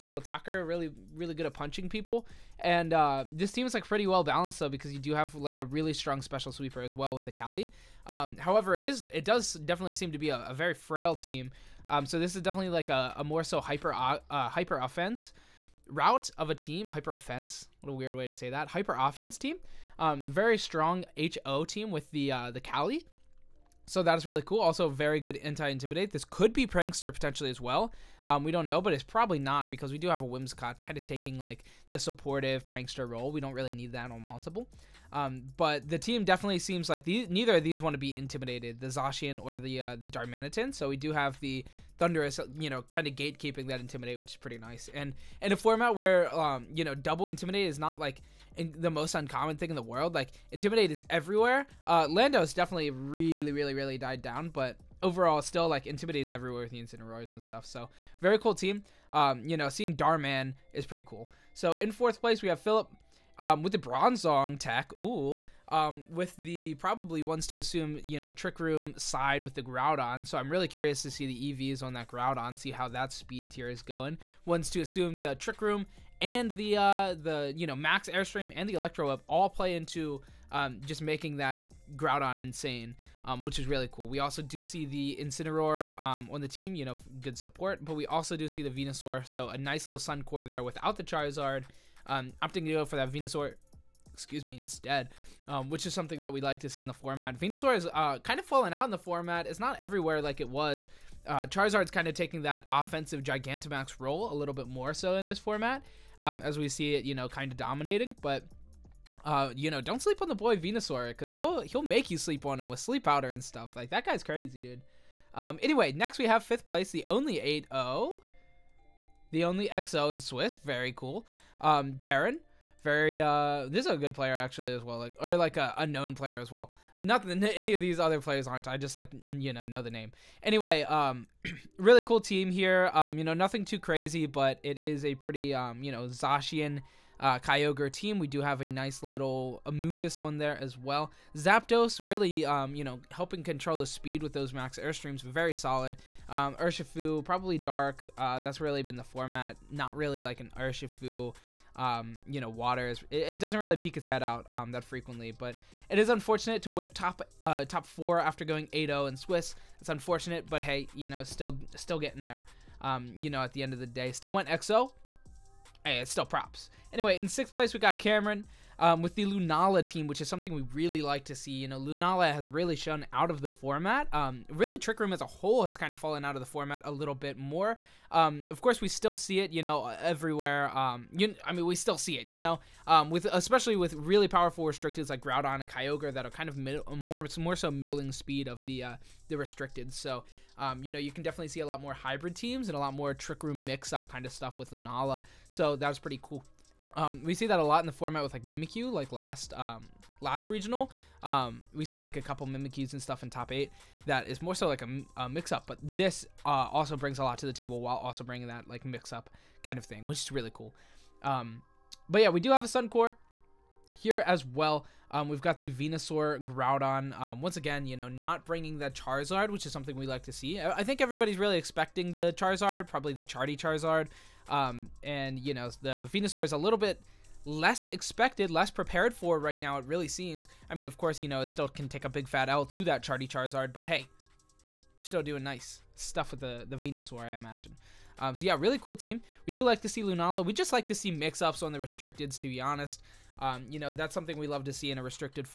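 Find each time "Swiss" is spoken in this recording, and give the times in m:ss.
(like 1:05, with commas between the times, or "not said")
2:00, 2:39.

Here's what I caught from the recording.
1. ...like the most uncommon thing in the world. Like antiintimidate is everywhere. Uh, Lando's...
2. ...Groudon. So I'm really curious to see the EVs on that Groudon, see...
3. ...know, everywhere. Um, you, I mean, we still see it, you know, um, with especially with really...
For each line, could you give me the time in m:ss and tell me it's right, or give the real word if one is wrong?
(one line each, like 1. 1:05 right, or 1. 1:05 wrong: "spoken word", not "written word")
1. 0:48 wrong: "intimidate", not "antiintimidate"
2. 1:09 right
3. 2:59 right.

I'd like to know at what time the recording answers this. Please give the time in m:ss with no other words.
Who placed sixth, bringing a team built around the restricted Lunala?
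2:47.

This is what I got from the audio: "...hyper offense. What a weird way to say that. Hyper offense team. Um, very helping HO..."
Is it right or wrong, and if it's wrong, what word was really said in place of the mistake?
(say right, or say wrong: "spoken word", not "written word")
wrong: "strong", not "helping".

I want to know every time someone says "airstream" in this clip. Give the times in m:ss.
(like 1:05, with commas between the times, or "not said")
1:18, 2:24.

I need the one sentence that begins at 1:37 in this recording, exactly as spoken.
Venusaur is uh, kind of fallen out in the format.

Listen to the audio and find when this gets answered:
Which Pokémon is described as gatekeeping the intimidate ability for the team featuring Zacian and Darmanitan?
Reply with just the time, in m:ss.
0:42.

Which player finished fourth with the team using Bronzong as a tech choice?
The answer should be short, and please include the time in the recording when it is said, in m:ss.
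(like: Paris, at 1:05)
Philip, at 1:02.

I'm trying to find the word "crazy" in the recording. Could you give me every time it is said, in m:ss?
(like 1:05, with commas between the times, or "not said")
1:54, 2:13.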